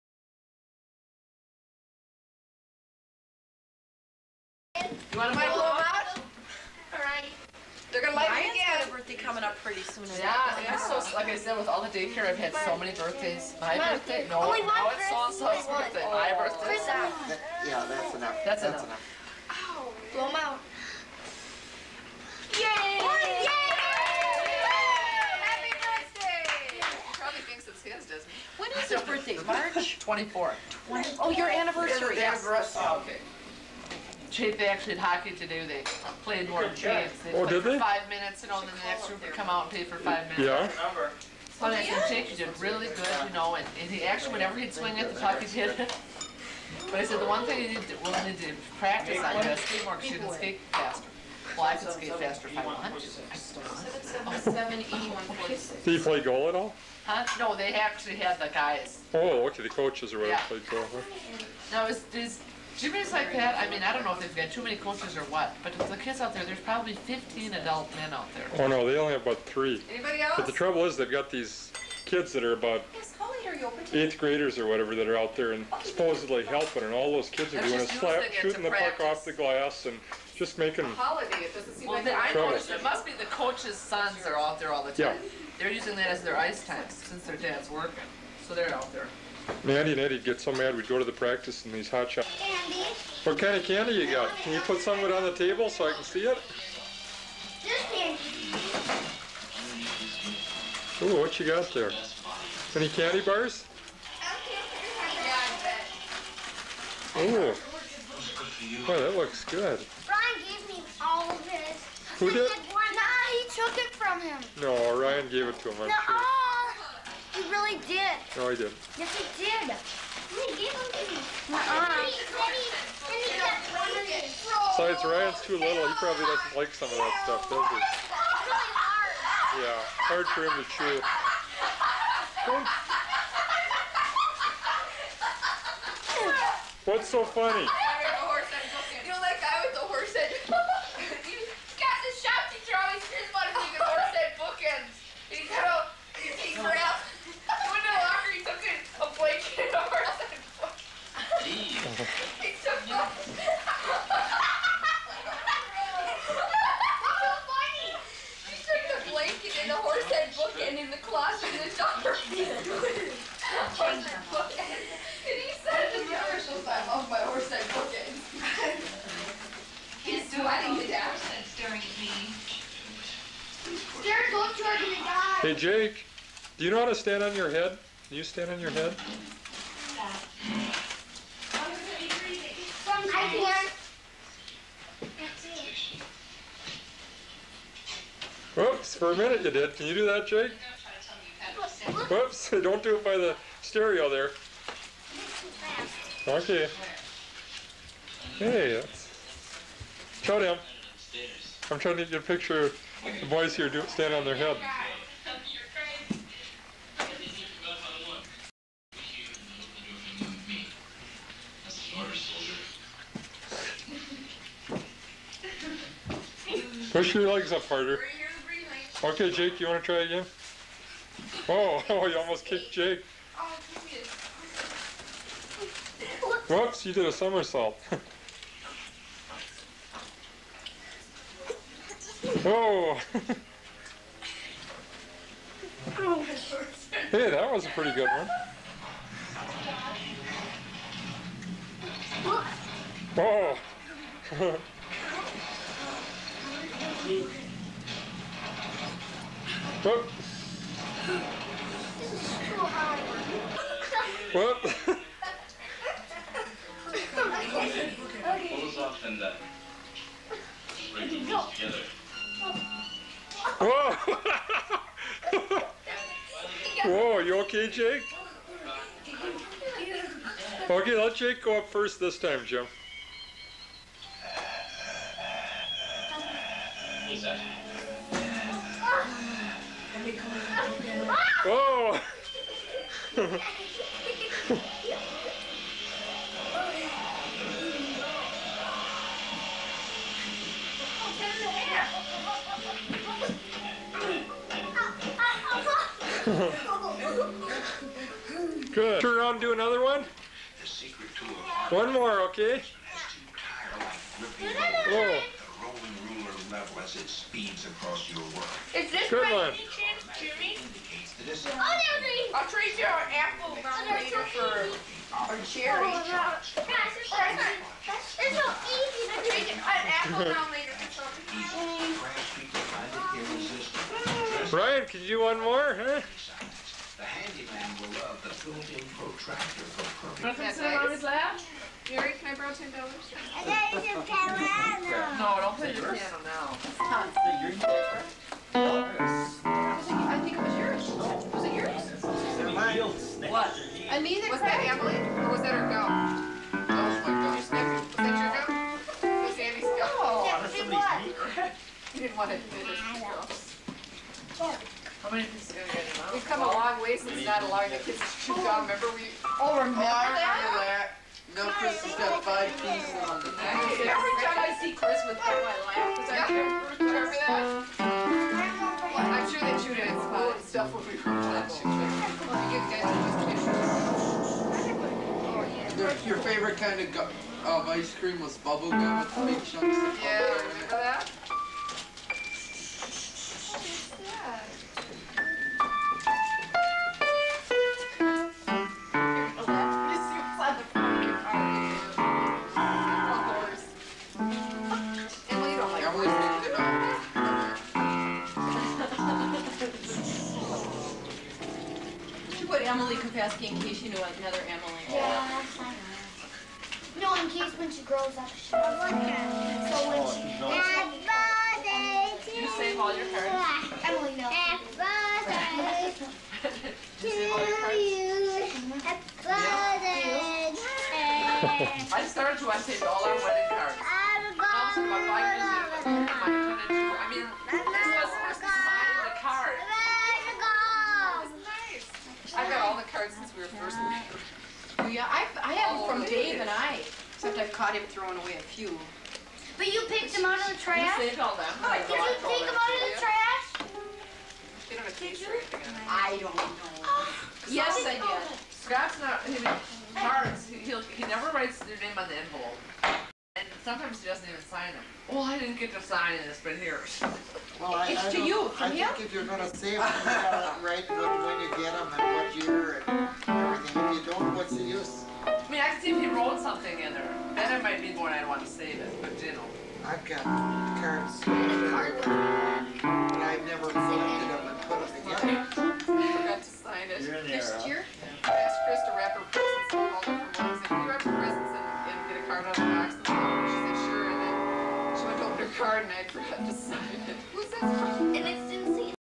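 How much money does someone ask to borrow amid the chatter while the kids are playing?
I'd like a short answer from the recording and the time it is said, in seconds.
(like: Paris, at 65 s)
$10, at 332 s.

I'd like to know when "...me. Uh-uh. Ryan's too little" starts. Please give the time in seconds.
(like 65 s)
121 s.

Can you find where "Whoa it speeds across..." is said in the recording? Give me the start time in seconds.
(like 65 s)
304 s.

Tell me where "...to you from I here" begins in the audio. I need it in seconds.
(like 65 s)
458 s.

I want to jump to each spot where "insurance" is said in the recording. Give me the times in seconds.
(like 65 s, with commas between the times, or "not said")
not said.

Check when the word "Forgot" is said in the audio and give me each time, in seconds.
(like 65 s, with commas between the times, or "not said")
475 s.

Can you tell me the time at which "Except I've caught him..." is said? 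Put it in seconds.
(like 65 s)
437 s.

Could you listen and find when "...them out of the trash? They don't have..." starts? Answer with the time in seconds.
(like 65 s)
442 s.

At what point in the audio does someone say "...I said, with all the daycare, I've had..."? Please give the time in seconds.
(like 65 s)
11 s.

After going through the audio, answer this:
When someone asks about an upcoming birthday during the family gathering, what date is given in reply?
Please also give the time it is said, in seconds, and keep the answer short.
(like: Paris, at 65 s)
March 24th, at 29 s.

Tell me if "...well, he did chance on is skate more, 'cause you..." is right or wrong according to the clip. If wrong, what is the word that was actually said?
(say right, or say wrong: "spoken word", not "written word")
wrong: "practice", not "chance".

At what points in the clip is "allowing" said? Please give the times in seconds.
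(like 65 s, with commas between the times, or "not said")
357 s.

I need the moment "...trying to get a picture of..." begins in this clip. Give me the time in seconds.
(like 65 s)
201 s.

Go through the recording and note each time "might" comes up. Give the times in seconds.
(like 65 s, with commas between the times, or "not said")
467 s.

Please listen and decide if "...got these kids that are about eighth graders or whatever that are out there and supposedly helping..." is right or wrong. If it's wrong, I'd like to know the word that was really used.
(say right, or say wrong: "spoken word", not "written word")
right.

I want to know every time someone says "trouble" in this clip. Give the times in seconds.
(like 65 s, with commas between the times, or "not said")
70 s.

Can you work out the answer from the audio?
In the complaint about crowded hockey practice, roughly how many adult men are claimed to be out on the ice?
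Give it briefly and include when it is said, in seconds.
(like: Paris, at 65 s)
15, at 66 s.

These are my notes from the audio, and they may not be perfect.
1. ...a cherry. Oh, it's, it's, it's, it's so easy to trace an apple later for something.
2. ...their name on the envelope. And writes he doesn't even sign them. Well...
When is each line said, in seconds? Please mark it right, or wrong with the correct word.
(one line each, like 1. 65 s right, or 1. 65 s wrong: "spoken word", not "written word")
1. 315 s right
2. 451 s wrong: "sometimes", not "writes".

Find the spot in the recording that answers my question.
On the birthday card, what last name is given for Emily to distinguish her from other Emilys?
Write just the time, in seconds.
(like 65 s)
402 s.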